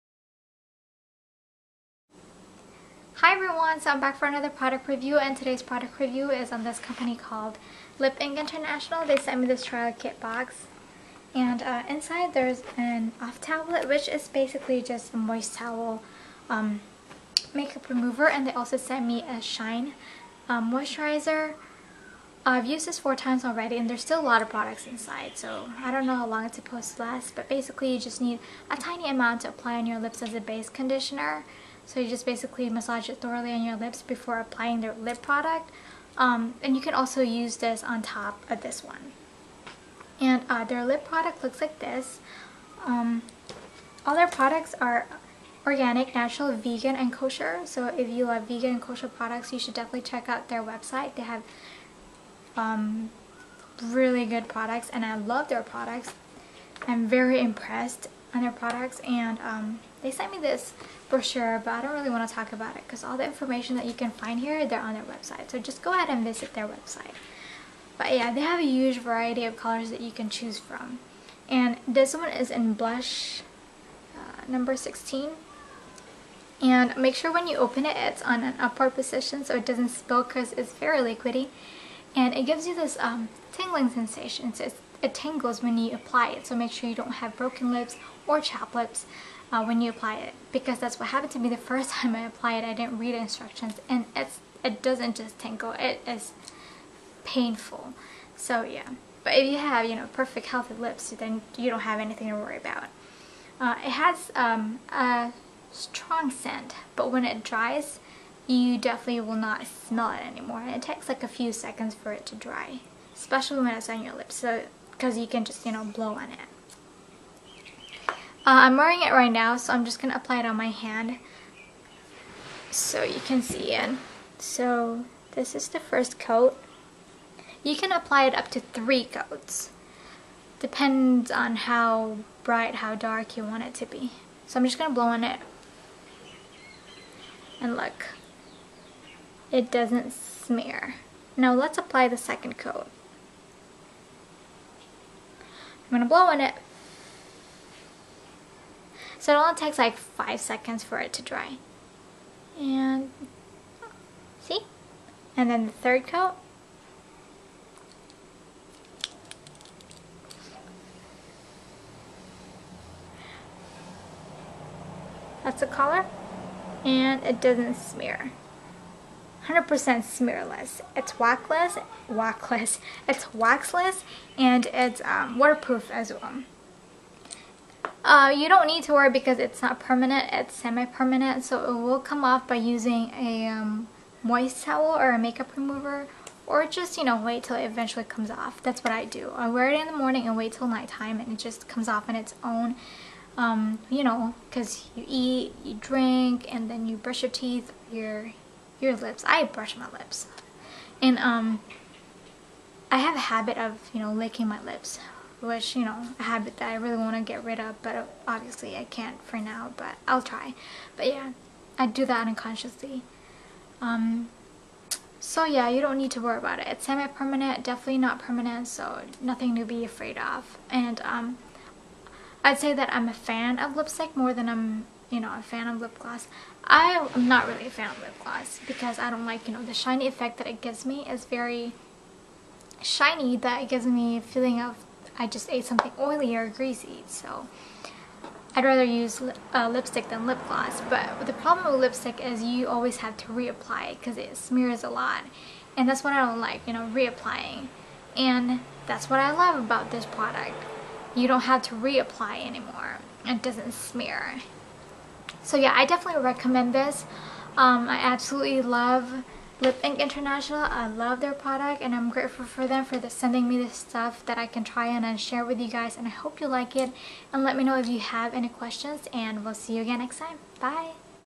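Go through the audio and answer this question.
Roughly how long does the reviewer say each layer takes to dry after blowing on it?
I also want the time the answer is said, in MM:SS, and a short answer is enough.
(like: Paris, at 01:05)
5 seconds, at 02:29.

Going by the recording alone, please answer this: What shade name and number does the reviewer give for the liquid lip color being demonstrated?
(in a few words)
Blush 16.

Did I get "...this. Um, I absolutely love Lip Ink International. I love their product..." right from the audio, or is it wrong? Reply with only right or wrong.
right.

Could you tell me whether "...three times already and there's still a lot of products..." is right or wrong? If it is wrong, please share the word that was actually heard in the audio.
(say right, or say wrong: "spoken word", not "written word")
wrong: "four", not "three".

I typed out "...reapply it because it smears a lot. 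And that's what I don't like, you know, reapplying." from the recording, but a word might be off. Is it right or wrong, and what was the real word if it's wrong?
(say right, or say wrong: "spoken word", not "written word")
right.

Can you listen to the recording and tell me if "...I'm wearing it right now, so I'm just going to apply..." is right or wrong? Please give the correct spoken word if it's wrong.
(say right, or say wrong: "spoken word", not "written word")
right.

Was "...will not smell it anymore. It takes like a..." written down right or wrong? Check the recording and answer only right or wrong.
right.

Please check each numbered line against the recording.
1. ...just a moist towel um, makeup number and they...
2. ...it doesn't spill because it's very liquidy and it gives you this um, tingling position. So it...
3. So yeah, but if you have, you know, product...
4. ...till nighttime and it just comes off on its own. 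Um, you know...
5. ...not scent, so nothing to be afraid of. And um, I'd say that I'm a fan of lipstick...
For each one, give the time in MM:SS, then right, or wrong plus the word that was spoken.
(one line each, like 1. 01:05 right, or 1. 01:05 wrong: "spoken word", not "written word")
1. 00:14 wrong: "remover", not "number"
2. 01:19 wrong: "sensation", not "position"
3. 01:38 wrong: "perfect", not "product"
4. 03:10 right
5. 03:37 wrong: "permanent", not "scent".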